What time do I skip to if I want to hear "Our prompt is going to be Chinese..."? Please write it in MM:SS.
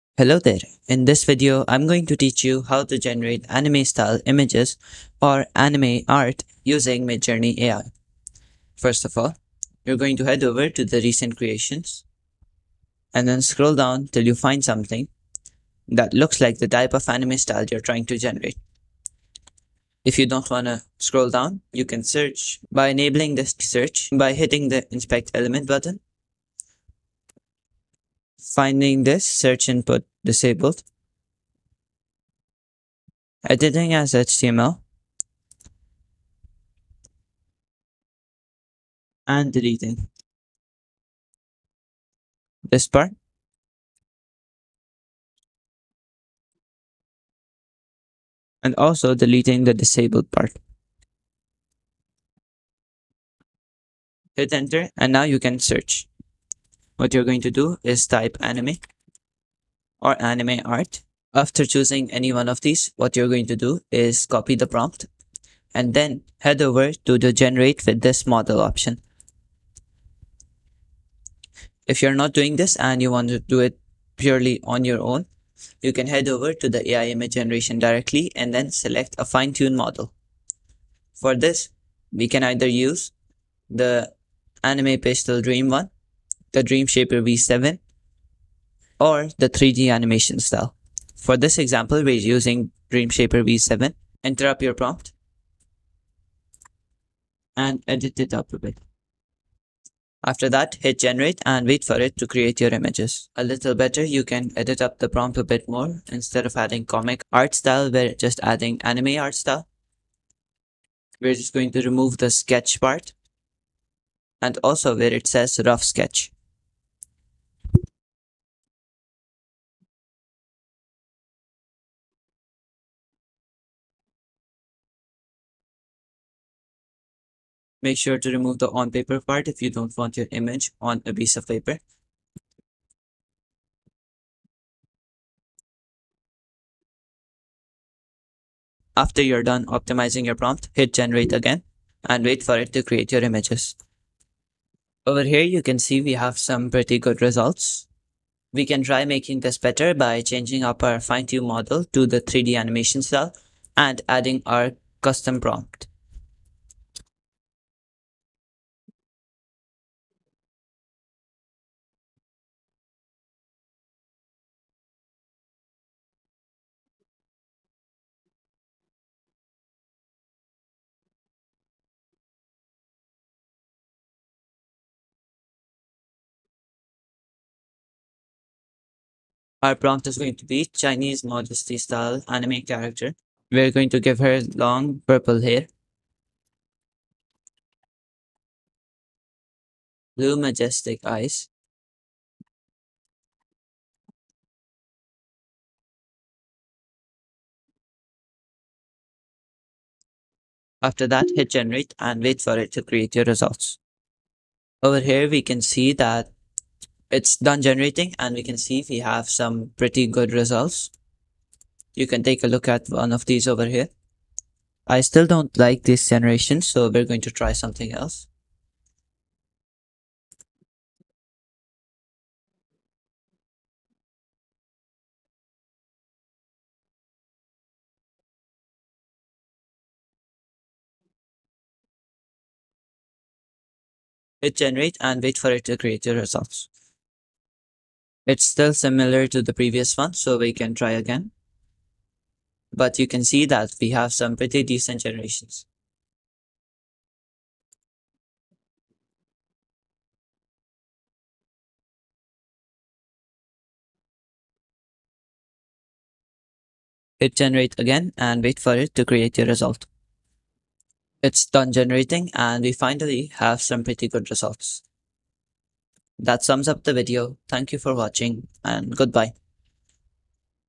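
02:59.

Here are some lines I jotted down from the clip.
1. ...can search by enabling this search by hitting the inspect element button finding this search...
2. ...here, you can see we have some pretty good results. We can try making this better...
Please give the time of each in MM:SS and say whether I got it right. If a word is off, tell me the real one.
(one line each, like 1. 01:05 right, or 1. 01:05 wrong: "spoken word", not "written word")
1. 00:21 right
2. 02:25 right.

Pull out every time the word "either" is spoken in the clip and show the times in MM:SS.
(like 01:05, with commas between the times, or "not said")
01:22.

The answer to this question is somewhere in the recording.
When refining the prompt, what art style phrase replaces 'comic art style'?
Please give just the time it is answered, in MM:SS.
01:47.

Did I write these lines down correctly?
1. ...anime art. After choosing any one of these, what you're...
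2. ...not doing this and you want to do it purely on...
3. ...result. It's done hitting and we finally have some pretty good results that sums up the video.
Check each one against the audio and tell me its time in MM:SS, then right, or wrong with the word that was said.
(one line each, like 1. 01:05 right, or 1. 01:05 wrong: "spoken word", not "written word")
1. 01:00 right
2. 01:12 right
3. 04:19 wrong: "generating", not "hitting".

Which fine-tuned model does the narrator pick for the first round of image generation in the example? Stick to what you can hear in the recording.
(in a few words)
DreamShaper V7.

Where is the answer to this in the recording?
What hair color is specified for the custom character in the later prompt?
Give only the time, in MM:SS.
03:04.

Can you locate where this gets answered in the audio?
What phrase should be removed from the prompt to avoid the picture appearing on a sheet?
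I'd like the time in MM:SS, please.
02:08.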